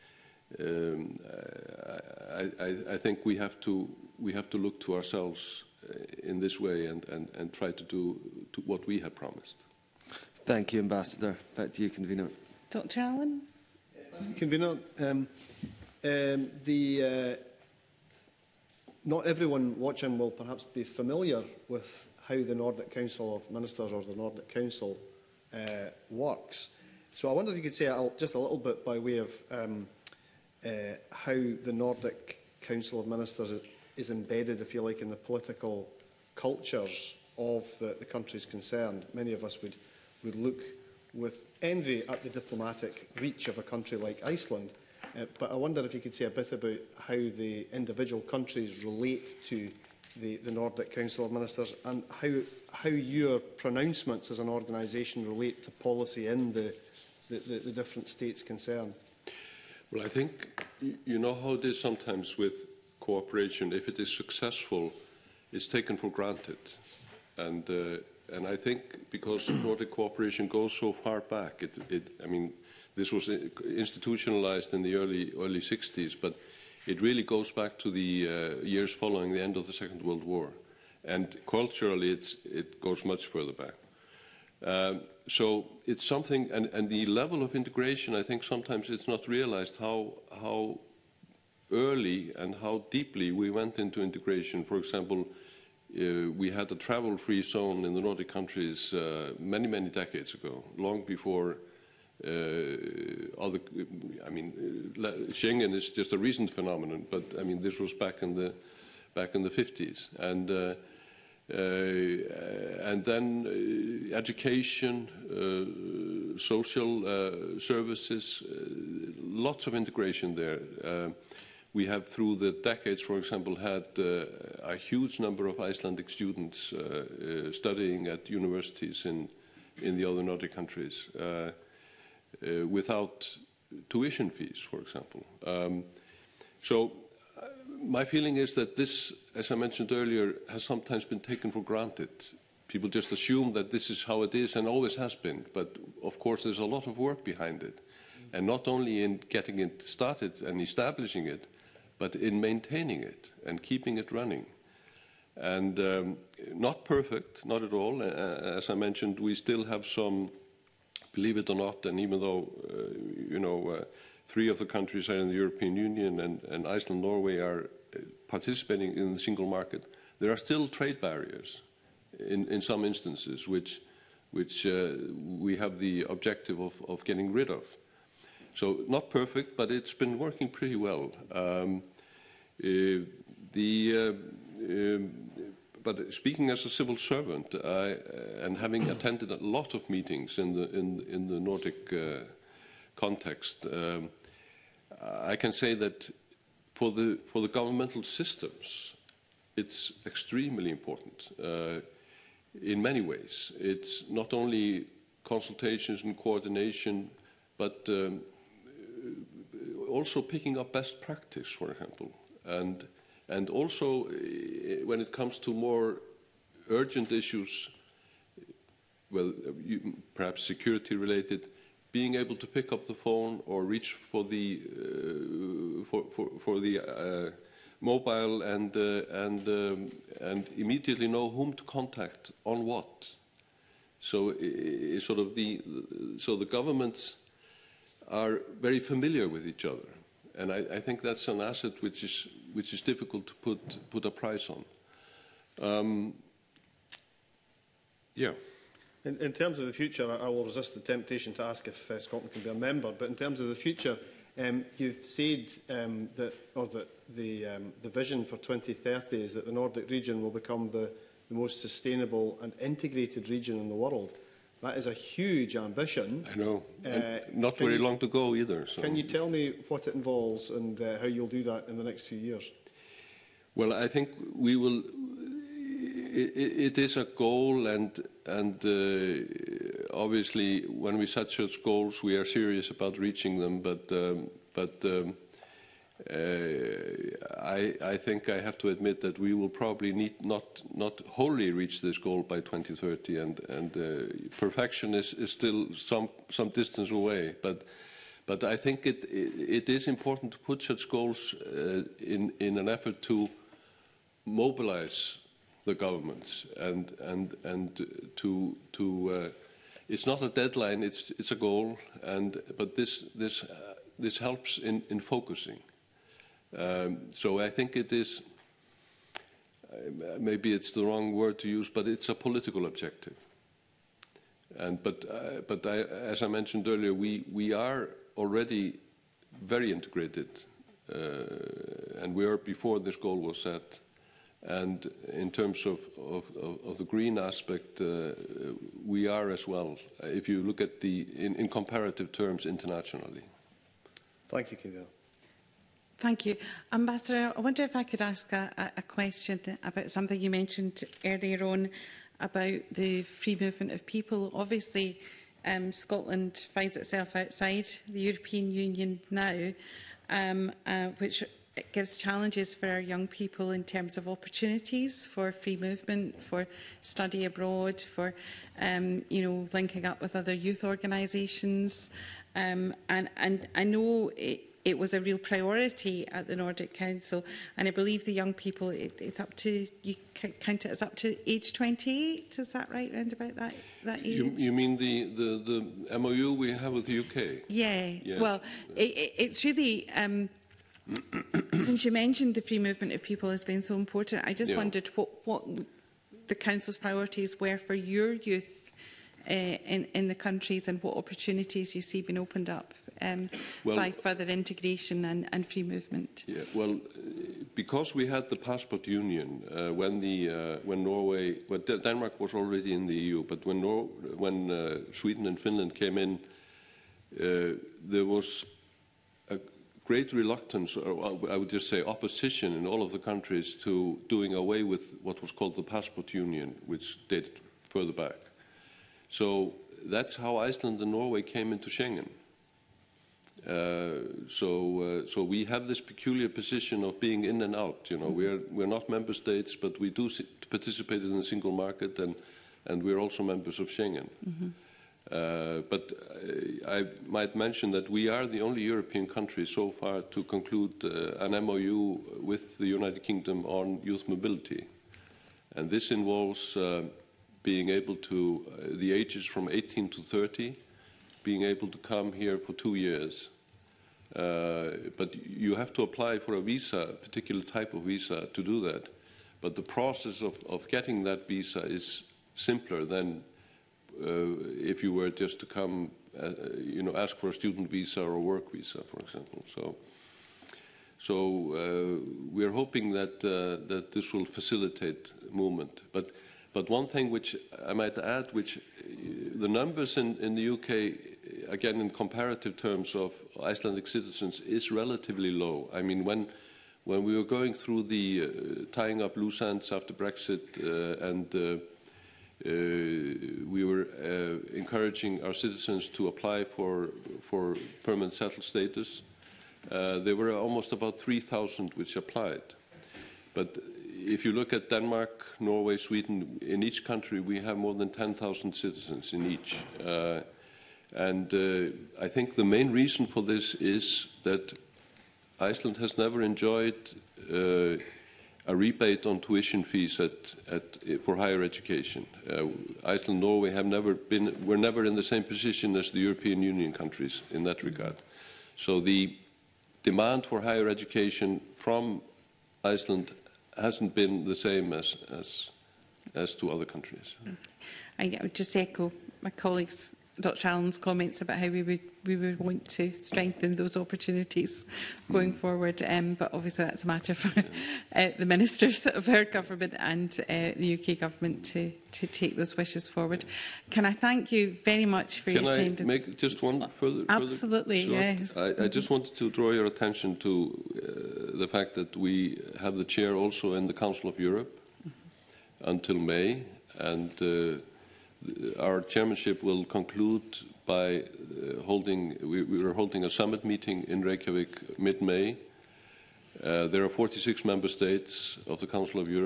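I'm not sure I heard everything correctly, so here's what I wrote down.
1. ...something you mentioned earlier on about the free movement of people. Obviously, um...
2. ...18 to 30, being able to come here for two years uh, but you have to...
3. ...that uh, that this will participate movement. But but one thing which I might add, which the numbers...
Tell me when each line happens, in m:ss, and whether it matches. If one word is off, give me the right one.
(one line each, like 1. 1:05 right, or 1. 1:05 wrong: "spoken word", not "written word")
1. 5:49 right
2. 7:39 right
3. 8:02 wrong: "facilitate", not "participate".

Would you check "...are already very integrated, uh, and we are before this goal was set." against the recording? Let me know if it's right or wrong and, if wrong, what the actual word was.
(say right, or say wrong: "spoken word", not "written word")
right.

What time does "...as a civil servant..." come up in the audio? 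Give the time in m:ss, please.
3:06.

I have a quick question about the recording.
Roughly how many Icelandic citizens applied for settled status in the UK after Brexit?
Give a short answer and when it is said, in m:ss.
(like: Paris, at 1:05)
3,000, at 8:30.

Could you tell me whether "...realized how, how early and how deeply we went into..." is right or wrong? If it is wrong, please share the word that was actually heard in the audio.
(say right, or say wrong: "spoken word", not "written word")
right.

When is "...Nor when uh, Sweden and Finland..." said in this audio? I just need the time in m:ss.
6:53.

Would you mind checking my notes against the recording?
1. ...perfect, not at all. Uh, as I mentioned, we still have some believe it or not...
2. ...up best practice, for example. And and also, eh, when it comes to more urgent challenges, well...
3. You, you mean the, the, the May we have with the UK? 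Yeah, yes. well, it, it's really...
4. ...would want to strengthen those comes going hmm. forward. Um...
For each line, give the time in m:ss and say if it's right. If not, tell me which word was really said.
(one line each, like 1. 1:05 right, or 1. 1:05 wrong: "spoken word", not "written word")
1. 2:36 right
2. 3:30 wrong: "issues", not "challenges"
3. 6:24 wrong: "MOU", not "May"
4. 9:12 wrong: "opportunities", not "comes".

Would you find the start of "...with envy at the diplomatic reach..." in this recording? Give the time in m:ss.
0:41.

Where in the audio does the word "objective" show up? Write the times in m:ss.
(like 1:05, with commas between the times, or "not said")
2:56, 5:22.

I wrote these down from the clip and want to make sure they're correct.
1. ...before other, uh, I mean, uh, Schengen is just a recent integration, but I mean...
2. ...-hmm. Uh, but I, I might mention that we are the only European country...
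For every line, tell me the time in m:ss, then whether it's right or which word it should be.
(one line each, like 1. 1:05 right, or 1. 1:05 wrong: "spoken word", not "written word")
1. 1:41 wrong: "phenomenon", not "integration"
2. 7:24 right.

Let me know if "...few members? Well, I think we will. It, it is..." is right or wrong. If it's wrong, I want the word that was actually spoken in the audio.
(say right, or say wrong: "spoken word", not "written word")
wrong: "years", not "members".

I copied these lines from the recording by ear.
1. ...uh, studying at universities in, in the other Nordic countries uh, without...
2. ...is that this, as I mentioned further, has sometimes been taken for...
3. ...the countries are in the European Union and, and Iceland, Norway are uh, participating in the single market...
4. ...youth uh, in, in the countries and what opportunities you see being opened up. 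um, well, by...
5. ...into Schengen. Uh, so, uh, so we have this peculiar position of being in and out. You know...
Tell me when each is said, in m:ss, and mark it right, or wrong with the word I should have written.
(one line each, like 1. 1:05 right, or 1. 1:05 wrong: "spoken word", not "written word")
1. 2:07 right
2. 2:18 wrong: "earlier", not "further"
3. 2:44 right
4. 6:38 right
5. 7:11 right.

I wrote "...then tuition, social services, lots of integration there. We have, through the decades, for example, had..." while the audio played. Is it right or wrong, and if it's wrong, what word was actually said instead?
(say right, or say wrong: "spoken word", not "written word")
wrong: "education", not "tuition".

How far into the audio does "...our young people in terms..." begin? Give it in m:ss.
6:02.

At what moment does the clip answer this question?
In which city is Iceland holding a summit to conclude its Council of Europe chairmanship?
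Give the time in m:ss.
9:44.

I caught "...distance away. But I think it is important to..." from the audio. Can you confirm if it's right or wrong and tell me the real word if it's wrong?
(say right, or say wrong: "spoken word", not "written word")
right.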